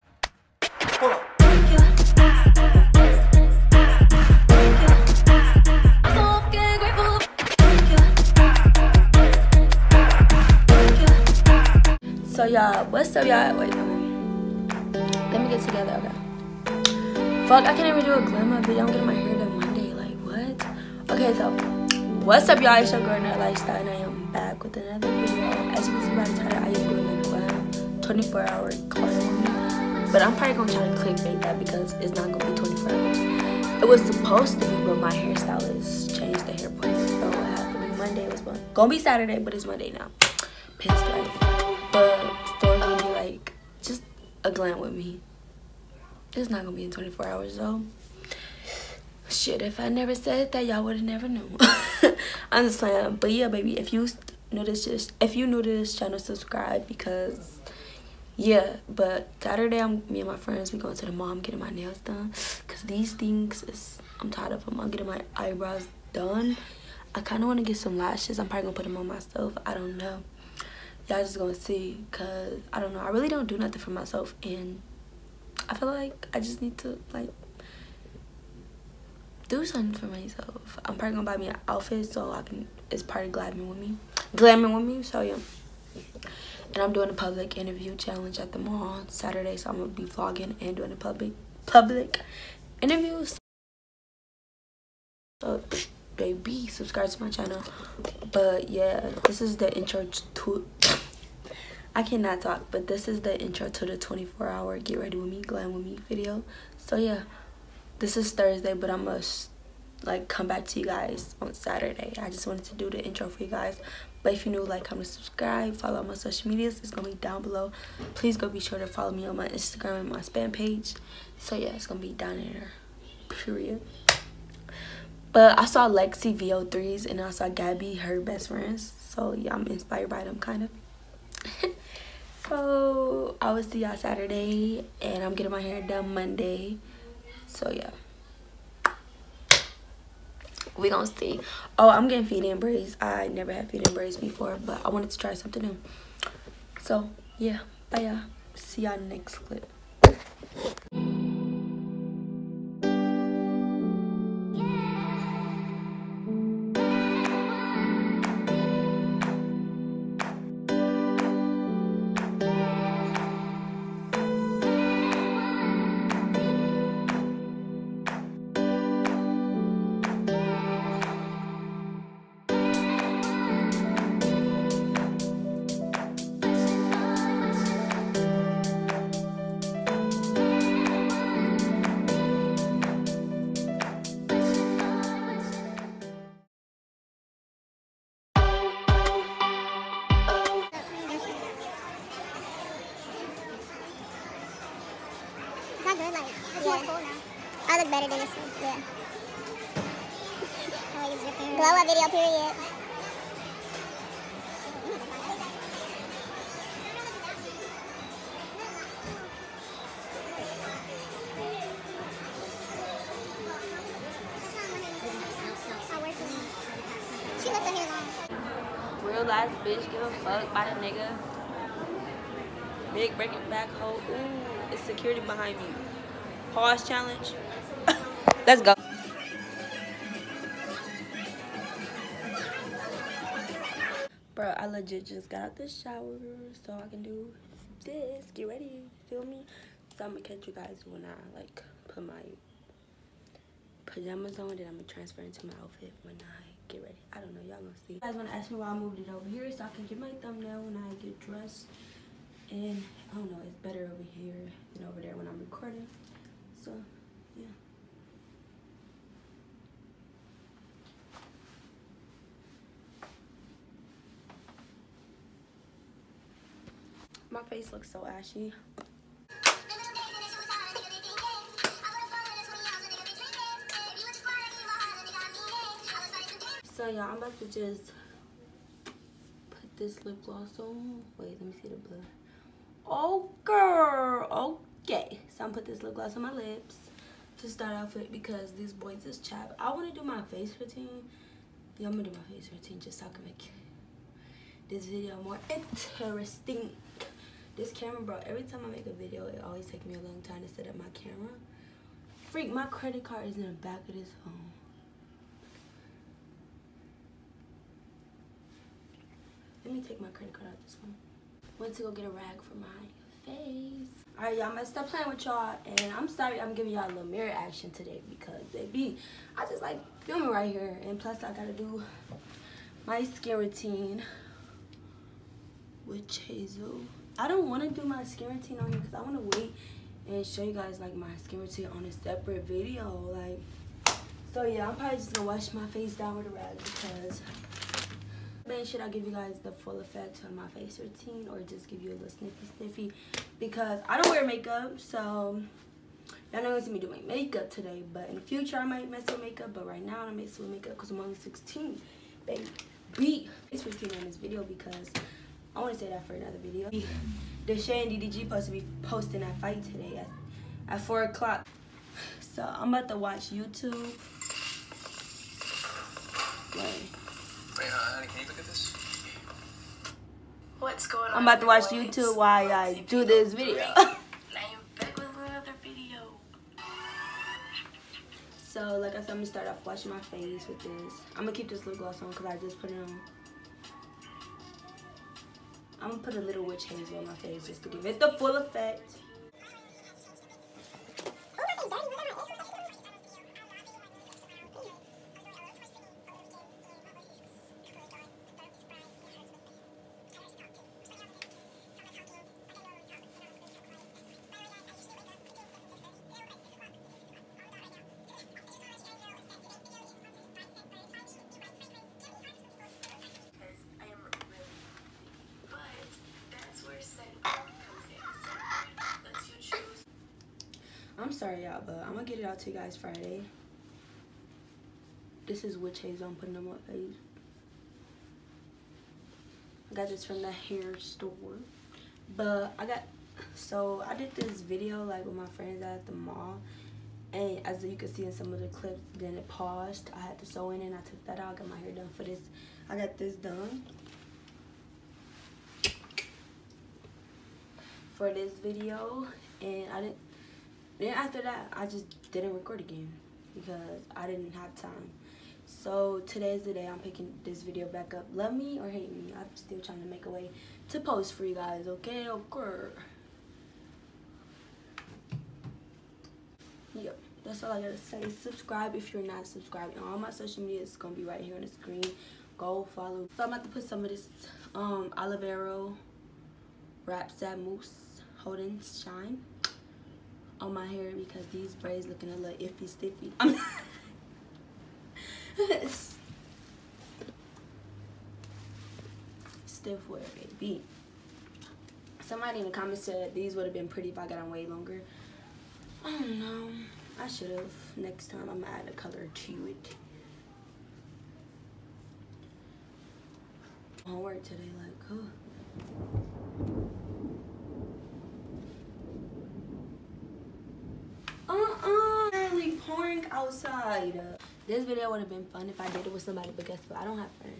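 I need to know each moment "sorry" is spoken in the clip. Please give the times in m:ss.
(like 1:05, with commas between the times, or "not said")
5:16, 7:01.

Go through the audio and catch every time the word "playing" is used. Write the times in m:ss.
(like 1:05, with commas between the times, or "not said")
0:52, 5:14.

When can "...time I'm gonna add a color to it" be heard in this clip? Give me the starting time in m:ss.
8:18.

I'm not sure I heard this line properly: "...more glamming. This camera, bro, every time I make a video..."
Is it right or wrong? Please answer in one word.
wrong.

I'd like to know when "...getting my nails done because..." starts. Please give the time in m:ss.
1:01.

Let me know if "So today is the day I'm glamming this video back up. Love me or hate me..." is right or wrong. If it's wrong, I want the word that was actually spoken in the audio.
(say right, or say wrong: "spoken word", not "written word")
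wrong: "picking", not "glamming".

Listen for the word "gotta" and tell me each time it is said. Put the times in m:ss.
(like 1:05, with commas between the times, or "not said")
5:21, 7:47.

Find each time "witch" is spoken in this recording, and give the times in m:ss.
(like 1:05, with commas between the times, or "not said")
6:26, 7:05.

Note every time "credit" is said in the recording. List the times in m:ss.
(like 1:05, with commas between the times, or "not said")
5:02, 5:10.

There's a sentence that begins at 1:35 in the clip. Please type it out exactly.
So baby, subscribe to my channel.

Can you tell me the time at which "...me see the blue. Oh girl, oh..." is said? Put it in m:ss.
4:41.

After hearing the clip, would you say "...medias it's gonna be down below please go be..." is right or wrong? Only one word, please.
right.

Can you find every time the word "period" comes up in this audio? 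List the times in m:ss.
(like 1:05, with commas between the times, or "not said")
2:03, 3:22.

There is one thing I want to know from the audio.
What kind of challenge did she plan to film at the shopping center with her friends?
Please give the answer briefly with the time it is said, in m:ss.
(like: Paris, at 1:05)
Public interview challenge, at 1:27.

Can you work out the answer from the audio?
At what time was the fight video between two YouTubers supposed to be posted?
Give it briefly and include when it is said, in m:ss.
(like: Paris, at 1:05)
4 o'clock, at 6:00.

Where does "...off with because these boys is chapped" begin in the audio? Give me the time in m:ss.
4:47.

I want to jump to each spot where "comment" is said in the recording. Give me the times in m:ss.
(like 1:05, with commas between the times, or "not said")
1:54, 8:12.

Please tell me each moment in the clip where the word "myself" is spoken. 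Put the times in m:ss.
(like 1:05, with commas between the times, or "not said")
1:09, 1:13, 1:20.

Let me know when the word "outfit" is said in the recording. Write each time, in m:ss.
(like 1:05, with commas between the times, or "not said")
1:21, 4:05.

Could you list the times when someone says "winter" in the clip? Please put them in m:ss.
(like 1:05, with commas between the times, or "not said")
not said.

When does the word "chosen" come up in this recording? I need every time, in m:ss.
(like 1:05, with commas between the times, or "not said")
not said.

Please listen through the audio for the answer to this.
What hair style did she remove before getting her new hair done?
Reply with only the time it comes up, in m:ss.
7:20.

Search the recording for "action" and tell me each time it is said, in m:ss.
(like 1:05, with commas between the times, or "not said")
5:17.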